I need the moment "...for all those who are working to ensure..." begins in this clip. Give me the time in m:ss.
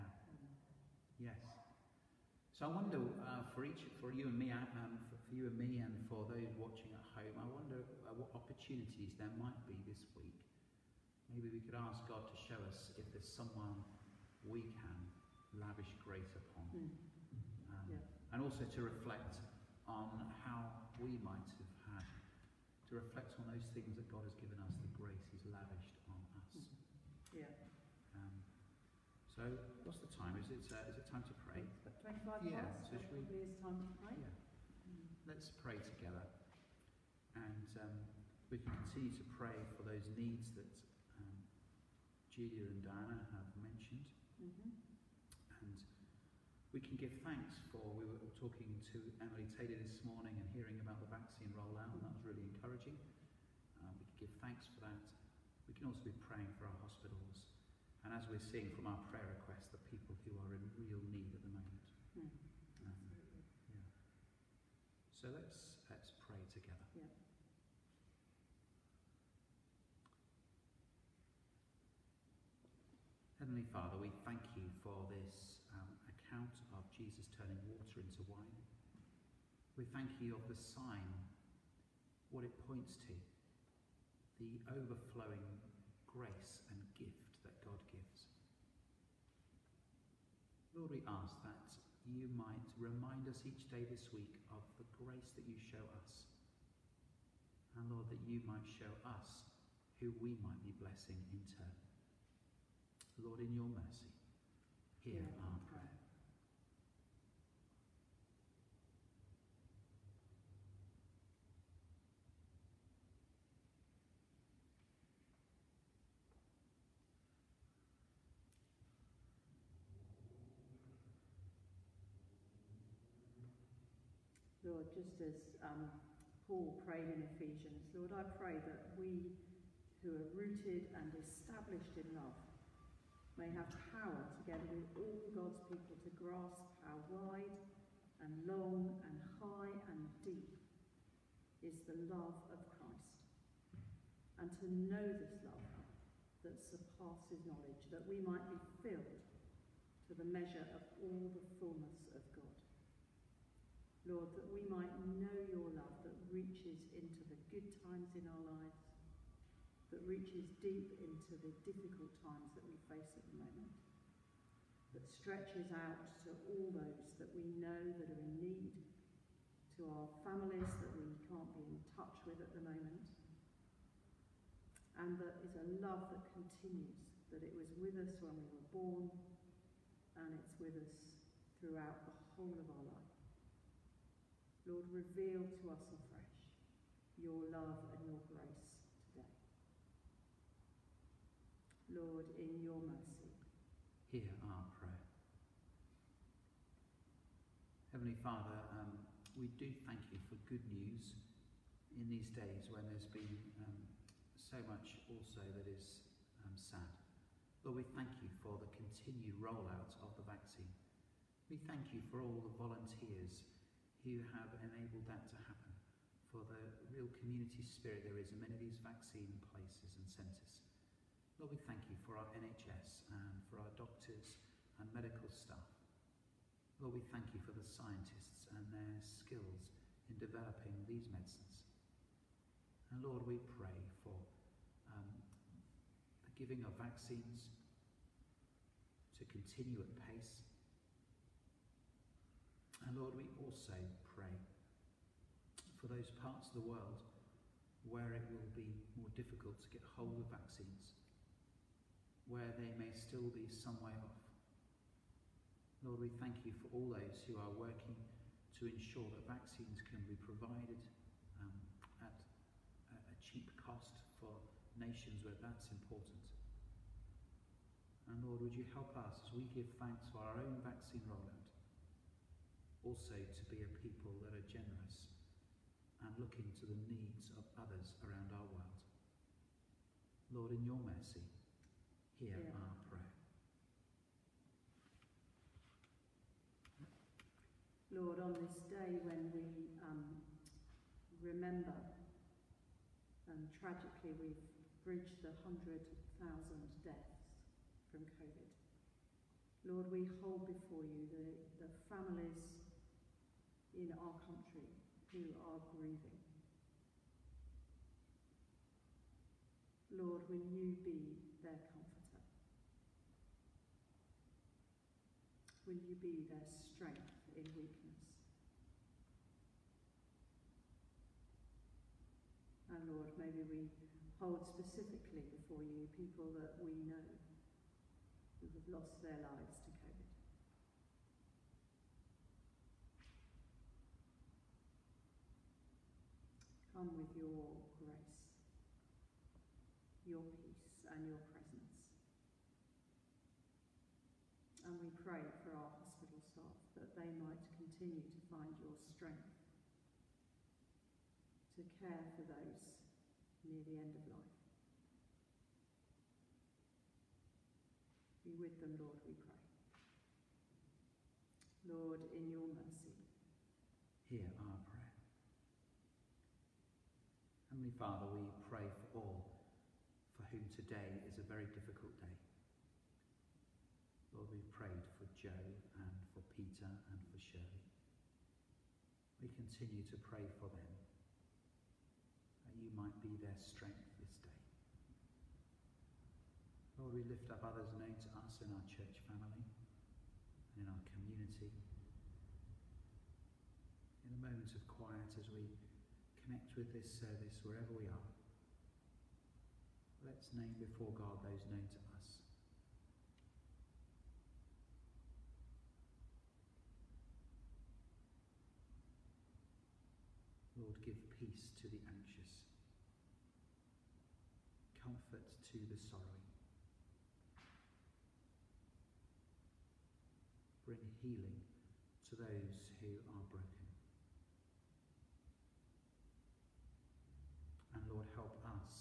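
4:16.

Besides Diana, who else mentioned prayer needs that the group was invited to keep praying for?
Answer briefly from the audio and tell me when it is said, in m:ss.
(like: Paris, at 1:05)
Julia, at 0:42.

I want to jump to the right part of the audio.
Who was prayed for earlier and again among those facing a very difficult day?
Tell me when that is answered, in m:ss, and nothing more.
6:15.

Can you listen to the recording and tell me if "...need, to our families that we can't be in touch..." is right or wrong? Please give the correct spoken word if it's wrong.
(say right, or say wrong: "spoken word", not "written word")
right.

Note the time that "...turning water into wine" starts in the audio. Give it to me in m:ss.
1:17.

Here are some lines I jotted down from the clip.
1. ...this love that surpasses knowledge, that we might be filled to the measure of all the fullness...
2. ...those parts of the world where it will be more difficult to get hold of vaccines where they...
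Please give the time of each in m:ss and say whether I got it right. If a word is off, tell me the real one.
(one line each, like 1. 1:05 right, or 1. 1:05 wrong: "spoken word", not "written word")
1. 2:25 right
2. 4:05 right.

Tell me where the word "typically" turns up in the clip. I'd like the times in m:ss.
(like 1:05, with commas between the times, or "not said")
not said.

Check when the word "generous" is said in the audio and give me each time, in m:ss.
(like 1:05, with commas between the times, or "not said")
4:34.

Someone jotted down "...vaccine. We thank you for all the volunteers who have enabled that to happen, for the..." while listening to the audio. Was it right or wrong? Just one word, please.
right.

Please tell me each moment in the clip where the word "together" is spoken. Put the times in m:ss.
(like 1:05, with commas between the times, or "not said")
0:35, 2:14.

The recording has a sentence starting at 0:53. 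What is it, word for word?
Uh, we can give thanks for that.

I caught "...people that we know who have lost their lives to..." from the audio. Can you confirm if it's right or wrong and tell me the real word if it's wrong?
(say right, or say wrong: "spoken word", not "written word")
right.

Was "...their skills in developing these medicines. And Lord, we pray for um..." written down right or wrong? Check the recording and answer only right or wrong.
right.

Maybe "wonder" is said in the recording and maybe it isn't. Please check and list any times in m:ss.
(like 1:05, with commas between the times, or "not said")
0:02, 0:07.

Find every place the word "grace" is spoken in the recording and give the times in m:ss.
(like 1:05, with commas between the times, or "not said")
0:15, 0:24, 1:26, 1:34, 3:08, 5:37.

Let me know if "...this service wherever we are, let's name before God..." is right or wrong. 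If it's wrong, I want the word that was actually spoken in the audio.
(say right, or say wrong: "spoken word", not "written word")
right.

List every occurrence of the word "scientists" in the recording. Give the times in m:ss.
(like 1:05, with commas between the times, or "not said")
3:47.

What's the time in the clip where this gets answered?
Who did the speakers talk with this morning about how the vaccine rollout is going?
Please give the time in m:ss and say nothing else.
0:49.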